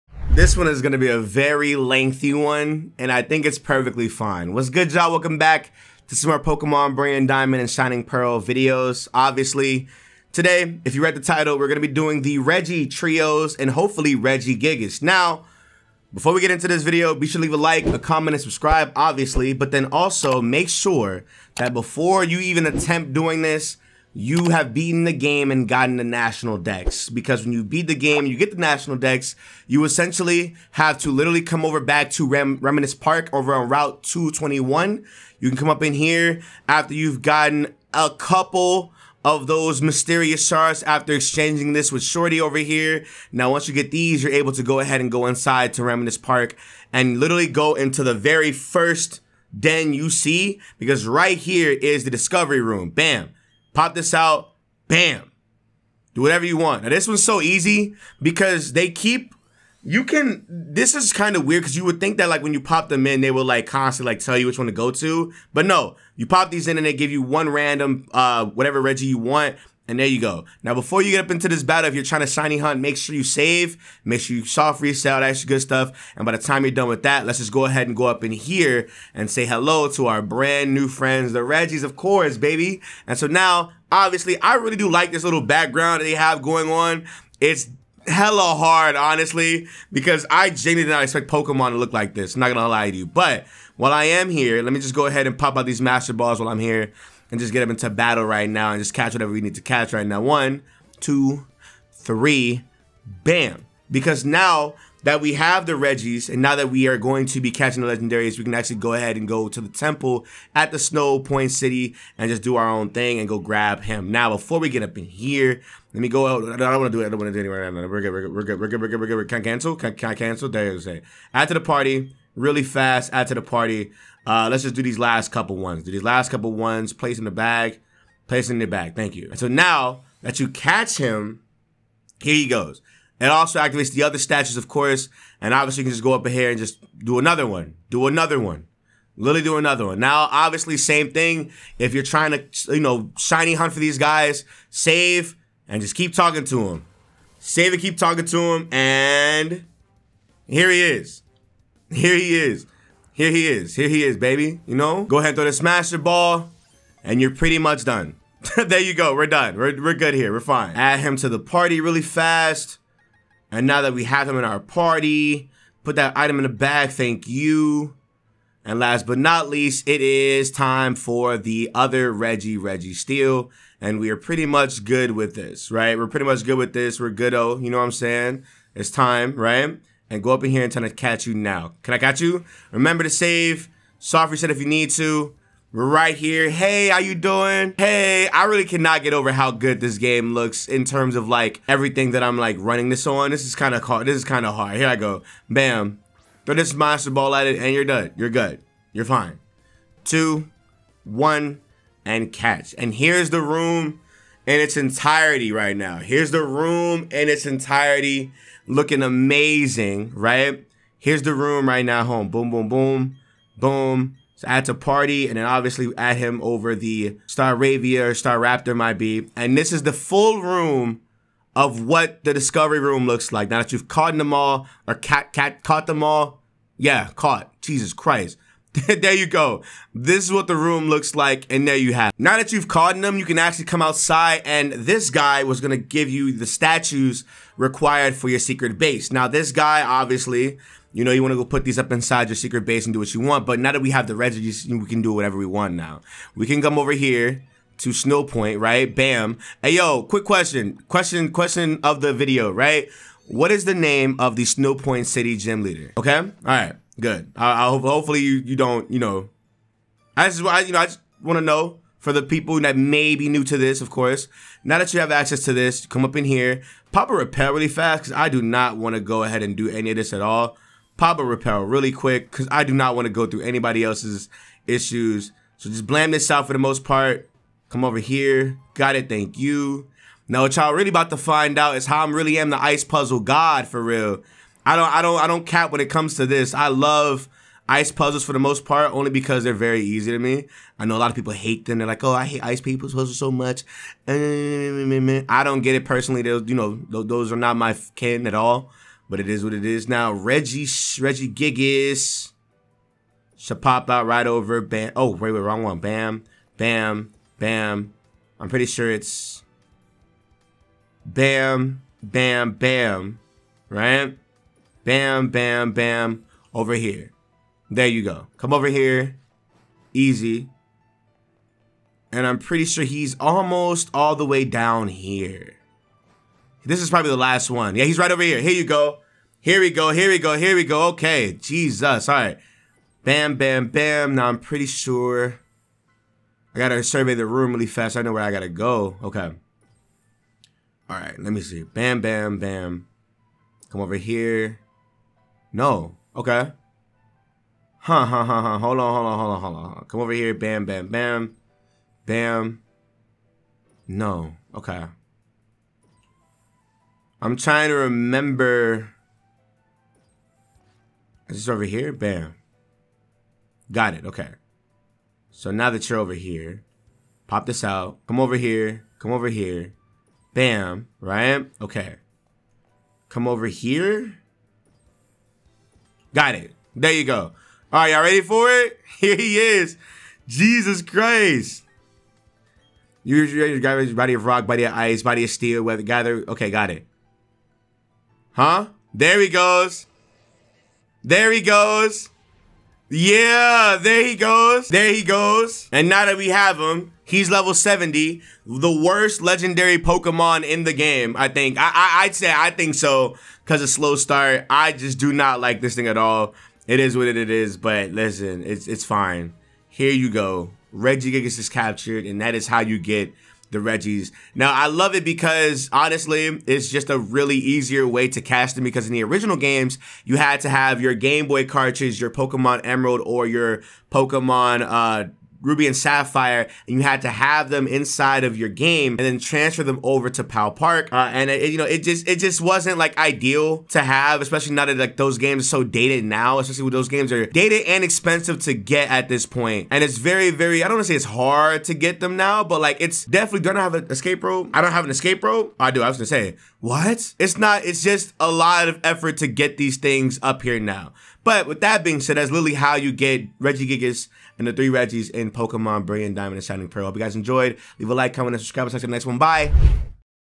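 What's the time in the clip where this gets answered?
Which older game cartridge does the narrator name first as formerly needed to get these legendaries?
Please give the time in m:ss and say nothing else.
7:02.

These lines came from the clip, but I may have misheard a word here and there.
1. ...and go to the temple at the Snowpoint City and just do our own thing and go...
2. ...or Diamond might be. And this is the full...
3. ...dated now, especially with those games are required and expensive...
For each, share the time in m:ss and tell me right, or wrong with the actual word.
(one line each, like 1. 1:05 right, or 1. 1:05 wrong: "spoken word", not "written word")
1. 1:49 right
2. 3:38 wrong: "Staraptor", not "Diamond"
3. 7:15 wrong: "dated", not "required".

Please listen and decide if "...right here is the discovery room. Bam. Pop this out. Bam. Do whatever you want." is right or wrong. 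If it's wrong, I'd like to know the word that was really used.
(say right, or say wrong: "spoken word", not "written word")
right.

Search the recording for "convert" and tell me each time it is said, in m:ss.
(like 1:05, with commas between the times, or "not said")
not said.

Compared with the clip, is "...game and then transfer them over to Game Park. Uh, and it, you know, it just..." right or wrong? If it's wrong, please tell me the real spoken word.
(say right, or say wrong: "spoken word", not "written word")
wrong: "Pal", not "Game".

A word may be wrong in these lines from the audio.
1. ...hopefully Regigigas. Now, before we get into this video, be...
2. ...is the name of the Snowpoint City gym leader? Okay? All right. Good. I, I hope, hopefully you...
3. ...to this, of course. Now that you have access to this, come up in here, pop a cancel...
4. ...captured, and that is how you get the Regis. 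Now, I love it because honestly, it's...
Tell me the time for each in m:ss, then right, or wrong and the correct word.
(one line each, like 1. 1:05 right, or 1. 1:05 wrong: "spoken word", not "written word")
1. 0:13 right
2. 4:13 right
3. 4:23 wrong: "repel", not "cancel"
4. 6:51 right.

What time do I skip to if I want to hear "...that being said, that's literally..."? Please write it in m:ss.
7:31.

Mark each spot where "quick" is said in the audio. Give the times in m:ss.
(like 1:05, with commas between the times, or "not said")
4:10, 4:31.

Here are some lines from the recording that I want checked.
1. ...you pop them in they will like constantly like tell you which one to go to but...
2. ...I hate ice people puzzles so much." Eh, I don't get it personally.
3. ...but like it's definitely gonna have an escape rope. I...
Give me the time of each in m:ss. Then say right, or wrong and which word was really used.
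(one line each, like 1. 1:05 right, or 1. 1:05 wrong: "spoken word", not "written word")
1. 1:02 right
2. 4:52 right
3. 7:22 right.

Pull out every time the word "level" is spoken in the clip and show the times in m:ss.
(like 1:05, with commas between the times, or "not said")
6:37.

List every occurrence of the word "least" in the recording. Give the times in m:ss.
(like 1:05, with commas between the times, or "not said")
2:49.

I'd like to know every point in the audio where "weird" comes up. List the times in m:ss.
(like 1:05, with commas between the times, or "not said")
1:01.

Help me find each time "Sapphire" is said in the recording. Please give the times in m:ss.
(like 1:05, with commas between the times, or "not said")
7:05.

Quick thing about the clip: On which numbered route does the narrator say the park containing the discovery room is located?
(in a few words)
Route 221.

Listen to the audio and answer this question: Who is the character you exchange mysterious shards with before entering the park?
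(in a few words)
Shorty.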